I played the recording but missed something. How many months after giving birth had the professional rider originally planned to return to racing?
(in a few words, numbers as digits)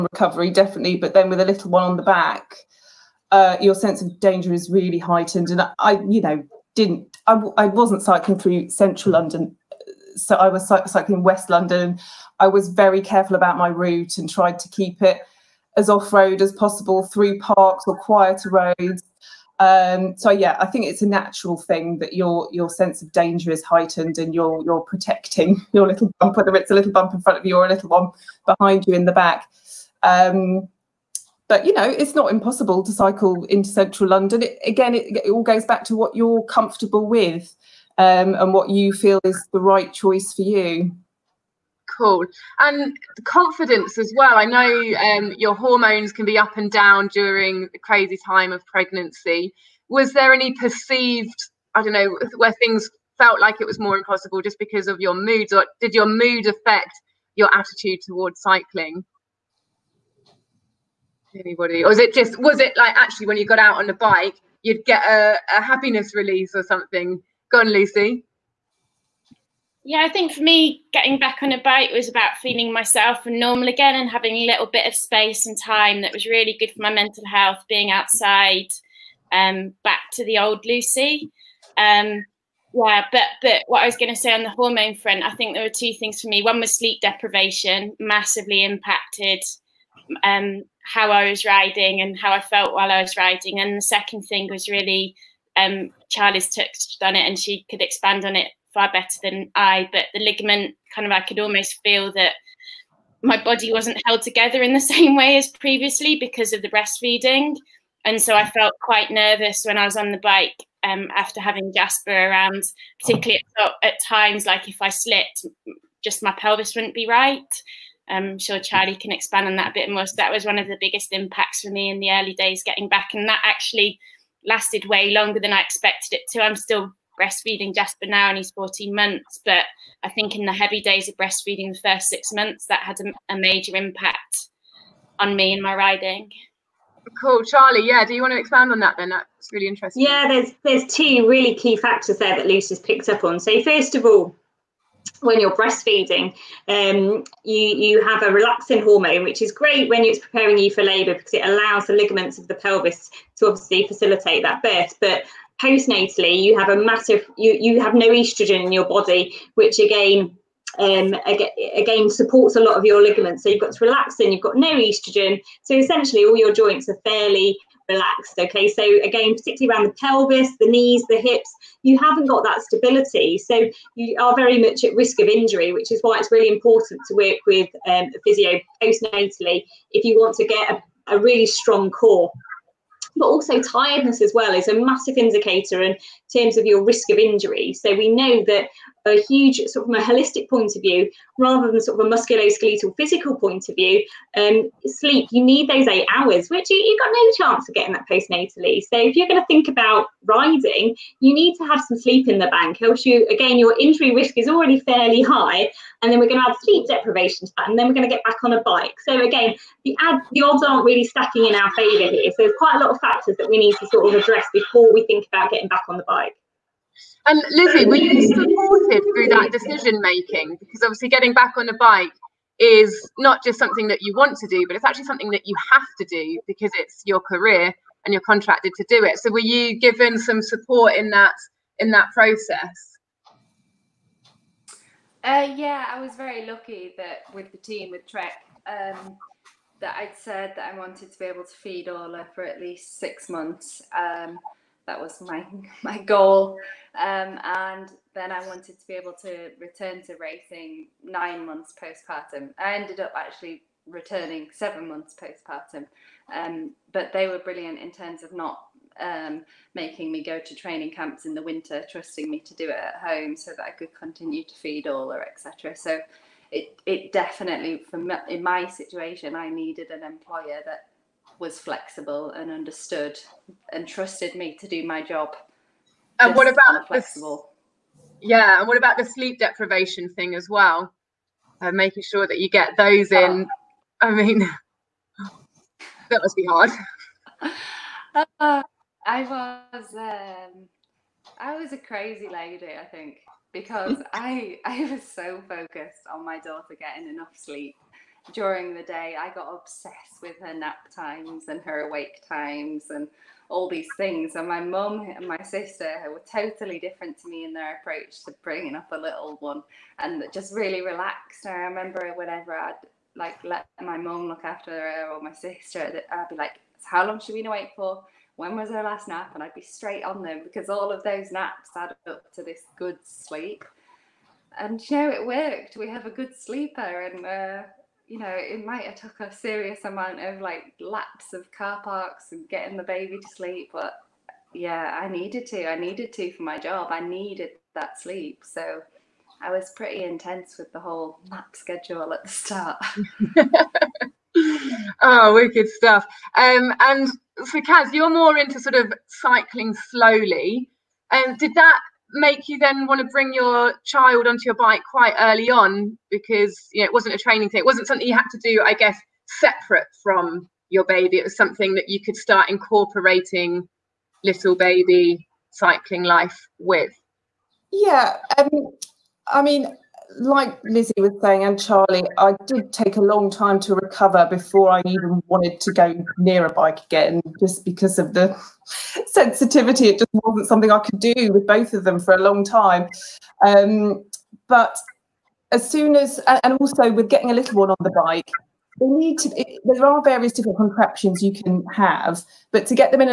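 9.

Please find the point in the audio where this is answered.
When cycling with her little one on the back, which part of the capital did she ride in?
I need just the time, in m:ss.
0:11.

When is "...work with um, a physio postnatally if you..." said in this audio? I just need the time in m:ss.
2:57.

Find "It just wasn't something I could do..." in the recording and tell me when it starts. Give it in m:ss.
6:19.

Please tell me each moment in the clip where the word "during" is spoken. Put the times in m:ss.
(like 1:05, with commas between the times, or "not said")
0:47, 4:58.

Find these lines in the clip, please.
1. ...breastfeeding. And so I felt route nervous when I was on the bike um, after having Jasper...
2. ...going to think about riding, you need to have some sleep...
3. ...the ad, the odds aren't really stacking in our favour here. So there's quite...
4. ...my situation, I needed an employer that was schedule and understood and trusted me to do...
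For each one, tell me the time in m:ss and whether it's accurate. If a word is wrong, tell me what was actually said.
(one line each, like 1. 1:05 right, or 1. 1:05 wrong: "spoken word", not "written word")
1. 1:46 wrong: "quite", not "route"
2. 3:19 right
3. 3:29 right
4. 4:28 wrong: "flexible", not "schedule".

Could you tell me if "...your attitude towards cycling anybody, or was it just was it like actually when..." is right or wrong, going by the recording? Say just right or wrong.
right.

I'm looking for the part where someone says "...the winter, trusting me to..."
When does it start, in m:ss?
4:21.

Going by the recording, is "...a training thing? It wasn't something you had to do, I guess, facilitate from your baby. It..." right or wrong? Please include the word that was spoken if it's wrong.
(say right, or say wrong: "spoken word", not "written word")
wrong: "separate", not "facilitate".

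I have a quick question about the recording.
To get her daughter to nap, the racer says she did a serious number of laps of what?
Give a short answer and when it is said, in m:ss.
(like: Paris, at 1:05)
car parks, at 5:31.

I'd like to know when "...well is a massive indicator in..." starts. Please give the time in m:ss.
3:04.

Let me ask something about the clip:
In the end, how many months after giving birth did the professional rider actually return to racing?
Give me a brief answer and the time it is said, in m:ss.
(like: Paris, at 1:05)
7, at 4:14.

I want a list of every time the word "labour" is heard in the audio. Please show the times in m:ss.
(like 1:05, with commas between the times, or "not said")
2:30.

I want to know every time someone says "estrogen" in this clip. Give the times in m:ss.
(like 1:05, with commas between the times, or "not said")
2:38, 2:44.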